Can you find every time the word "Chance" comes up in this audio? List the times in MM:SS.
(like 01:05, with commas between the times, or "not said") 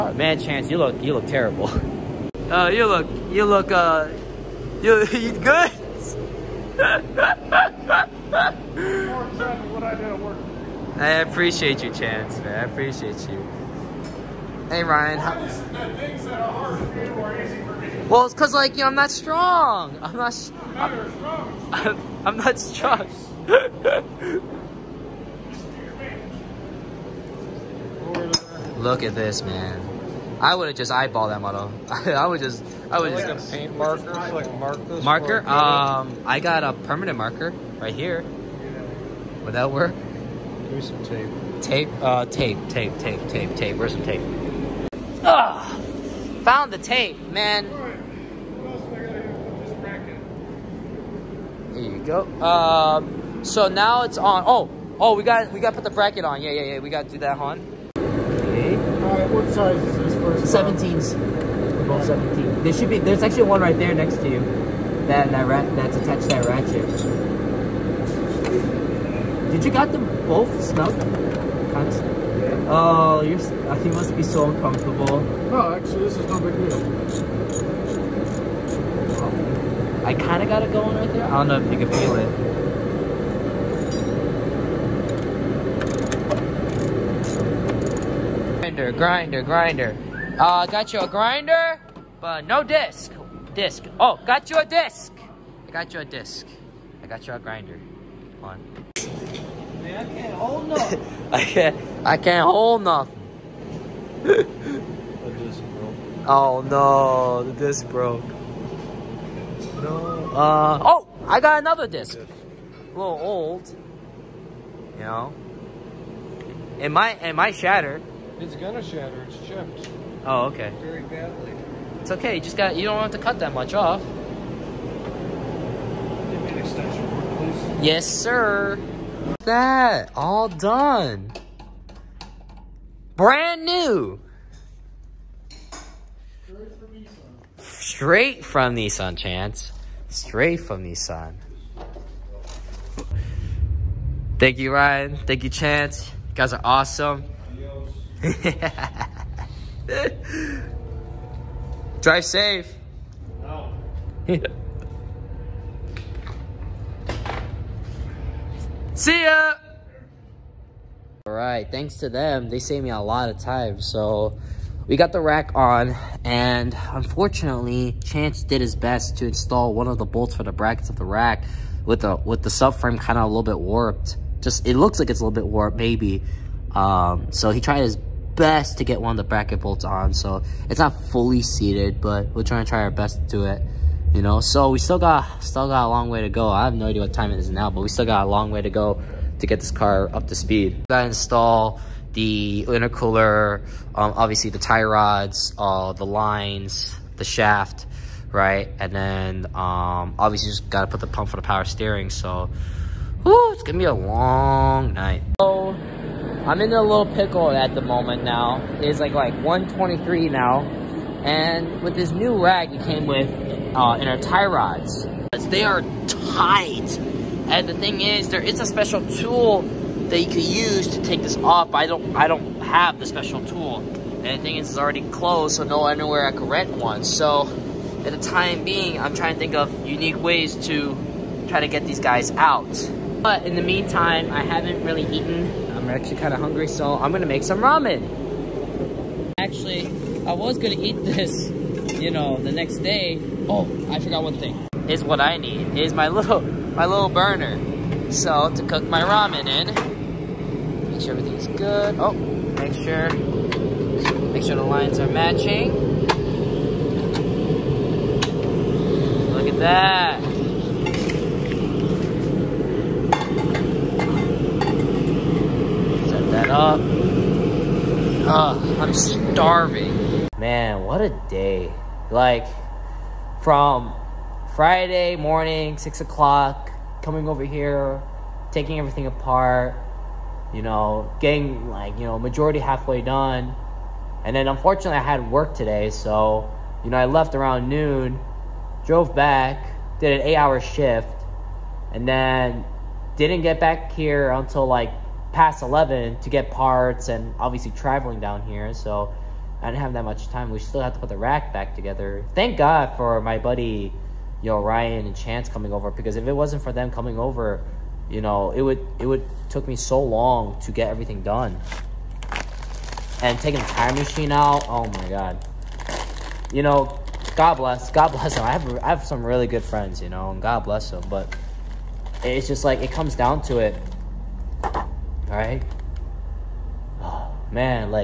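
00:00, 00:11, 02:19, 02:25, 02:48, 05:05.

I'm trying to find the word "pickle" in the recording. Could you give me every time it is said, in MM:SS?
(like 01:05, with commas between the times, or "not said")
03:27.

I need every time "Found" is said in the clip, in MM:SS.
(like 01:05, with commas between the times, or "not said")
00:46.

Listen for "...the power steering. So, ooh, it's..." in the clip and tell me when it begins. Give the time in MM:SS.
03:21.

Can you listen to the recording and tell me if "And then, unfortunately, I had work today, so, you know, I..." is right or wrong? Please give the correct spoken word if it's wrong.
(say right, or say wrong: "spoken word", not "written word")
right.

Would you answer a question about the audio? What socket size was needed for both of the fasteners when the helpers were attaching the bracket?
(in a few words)
17.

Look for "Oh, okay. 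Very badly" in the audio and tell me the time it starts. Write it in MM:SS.
02:00.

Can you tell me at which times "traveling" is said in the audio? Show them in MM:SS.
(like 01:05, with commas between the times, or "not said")
04:57.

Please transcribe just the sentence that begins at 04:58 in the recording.
So I didn't have that much time.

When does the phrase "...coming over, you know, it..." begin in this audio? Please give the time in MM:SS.
05:06.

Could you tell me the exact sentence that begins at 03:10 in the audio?
Gotta install the intercooler, um, obviously the tie rods, uh, the lines, the shaft, right?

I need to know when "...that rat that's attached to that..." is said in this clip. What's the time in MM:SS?
01:05.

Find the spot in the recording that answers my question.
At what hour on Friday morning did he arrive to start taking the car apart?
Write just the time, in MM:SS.
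04:35.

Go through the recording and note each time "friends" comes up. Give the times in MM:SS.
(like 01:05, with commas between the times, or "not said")
05:19.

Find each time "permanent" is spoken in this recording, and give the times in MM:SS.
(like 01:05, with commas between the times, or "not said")
00:36.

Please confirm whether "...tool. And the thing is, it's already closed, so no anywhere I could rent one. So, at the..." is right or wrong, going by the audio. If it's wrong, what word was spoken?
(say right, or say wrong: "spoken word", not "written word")
right.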